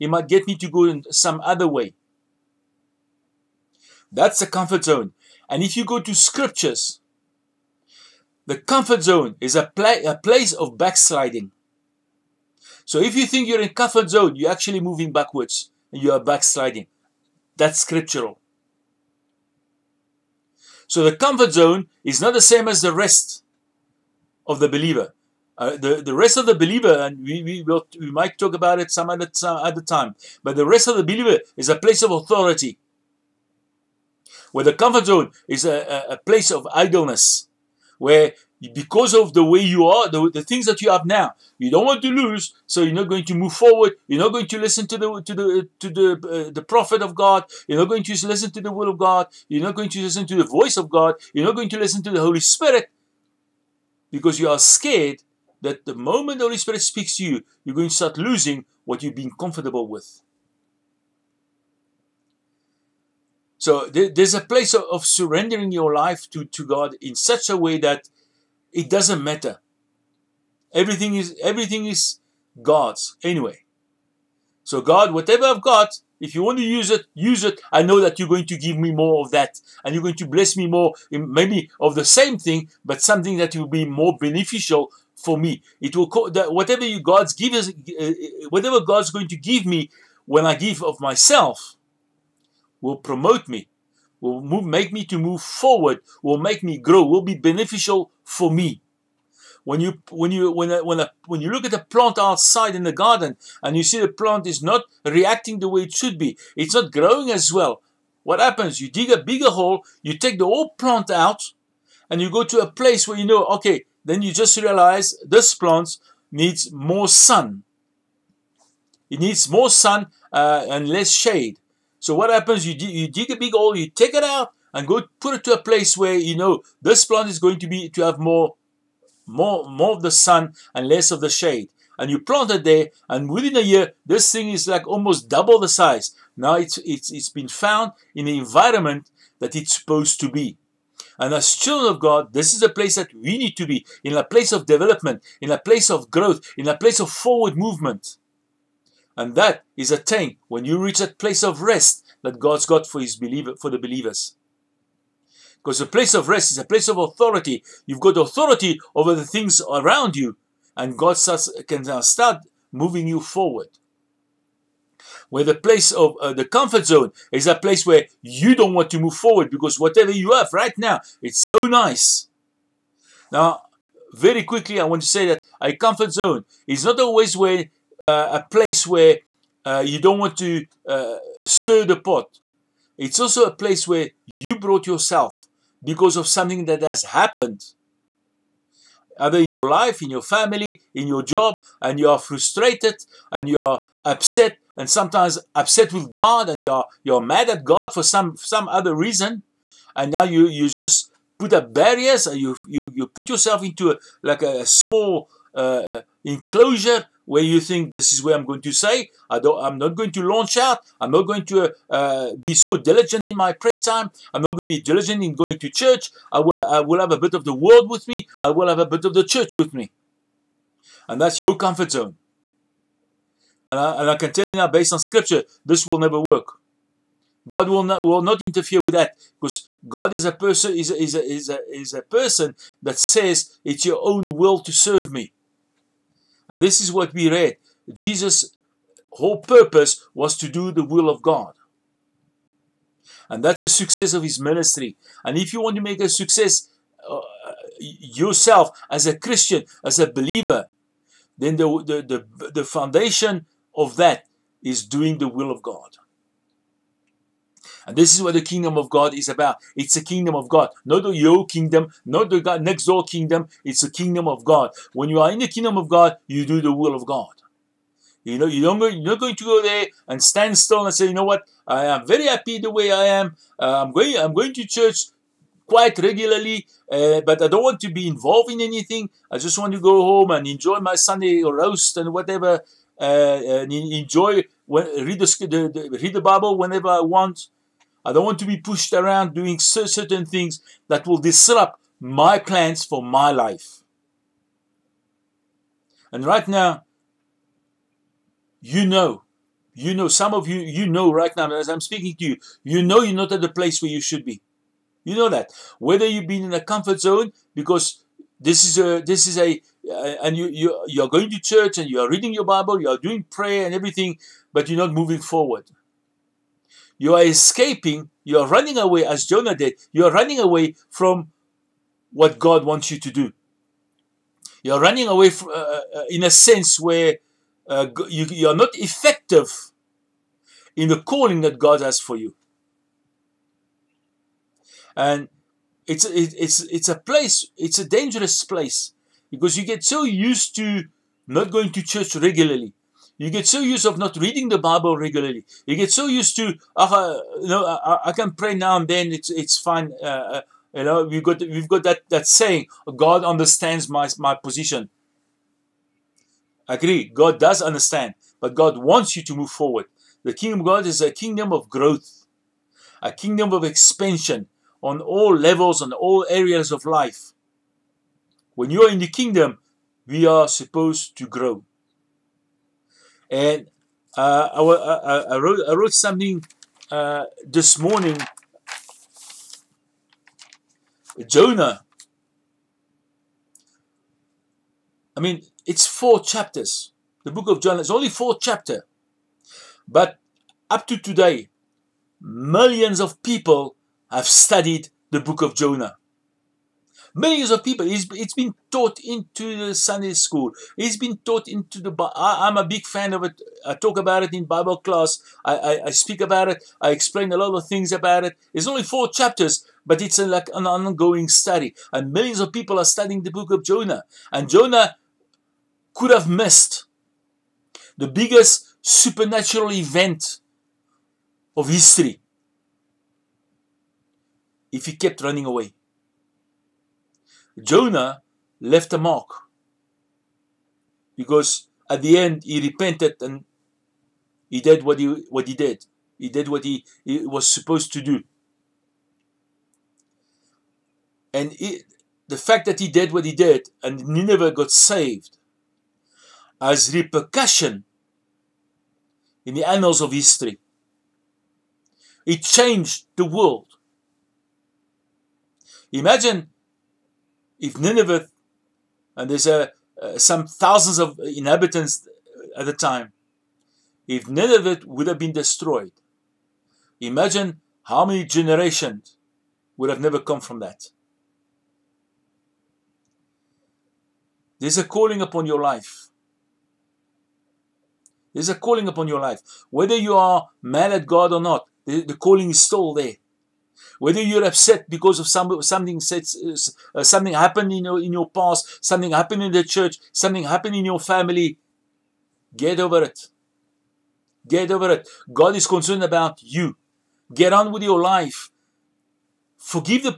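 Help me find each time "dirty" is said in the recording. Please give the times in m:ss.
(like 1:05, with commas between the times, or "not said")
not said.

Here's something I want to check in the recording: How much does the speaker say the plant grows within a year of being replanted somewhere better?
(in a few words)
almost double the size.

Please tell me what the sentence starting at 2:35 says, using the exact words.
Because the place of rest is a place of authority.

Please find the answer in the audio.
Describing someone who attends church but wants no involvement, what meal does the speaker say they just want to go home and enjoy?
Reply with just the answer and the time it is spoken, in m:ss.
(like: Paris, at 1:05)
Sunday roast, at 4:40.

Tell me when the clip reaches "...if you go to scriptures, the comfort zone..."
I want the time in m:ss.
0:05.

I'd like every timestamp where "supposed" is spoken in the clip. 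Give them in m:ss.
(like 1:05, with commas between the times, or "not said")
2:19, 6:10, 7:17.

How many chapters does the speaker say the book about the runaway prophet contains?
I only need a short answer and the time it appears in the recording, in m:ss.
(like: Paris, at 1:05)
4, at 6:28.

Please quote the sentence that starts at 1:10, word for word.
Everything is everything is God's anyway.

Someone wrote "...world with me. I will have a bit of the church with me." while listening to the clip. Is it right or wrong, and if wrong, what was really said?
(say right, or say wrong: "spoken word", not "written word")
right.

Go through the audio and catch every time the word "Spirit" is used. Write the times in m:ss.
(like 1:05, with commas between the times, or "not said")
0:52, 0:56.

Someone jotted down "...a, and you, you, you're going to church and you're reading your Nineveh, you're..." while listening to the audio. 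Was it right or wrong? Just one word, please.
wrong.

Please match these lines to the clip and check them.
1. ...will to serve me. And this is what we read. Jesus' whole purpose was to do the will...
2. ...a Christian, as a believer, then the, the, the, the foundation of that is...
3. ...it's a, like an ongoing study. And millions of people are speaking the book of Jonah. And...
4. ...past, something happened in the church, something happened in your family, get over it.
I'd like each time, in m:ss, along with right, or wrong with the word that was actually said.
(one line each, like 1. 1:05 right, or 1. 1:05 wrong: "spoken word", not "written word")
1. 3:54 right
2. 4:09 right
3. 6:50 wrong: "studying", not "speaking"
4. 8:08 right.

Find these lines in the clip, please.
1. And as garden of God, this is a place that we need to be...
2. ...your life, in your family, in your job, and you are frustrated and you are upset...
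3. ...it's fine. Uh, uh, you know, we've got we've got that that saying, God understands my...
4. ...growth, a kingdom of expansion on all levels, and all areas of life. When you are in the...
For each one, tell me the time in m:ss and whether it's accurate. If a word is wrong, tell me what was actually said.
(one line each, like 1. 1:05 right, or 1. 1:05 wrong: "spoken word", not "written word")
1. 2:21 wrong: "children", not "garden"
2. 3:09 right
3. 5:49 right
4. 6:01 right.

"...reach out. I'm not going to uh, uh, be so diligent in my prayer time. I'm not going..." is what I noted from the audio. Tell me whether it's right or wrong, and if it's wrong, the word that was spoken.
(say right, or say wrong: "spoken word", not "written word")
wrong: "launch", not "reach".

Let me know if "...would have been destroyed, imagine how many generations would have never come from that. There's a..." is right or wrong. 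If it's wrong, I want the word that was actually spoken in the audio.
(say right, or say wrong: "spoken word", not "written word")
right.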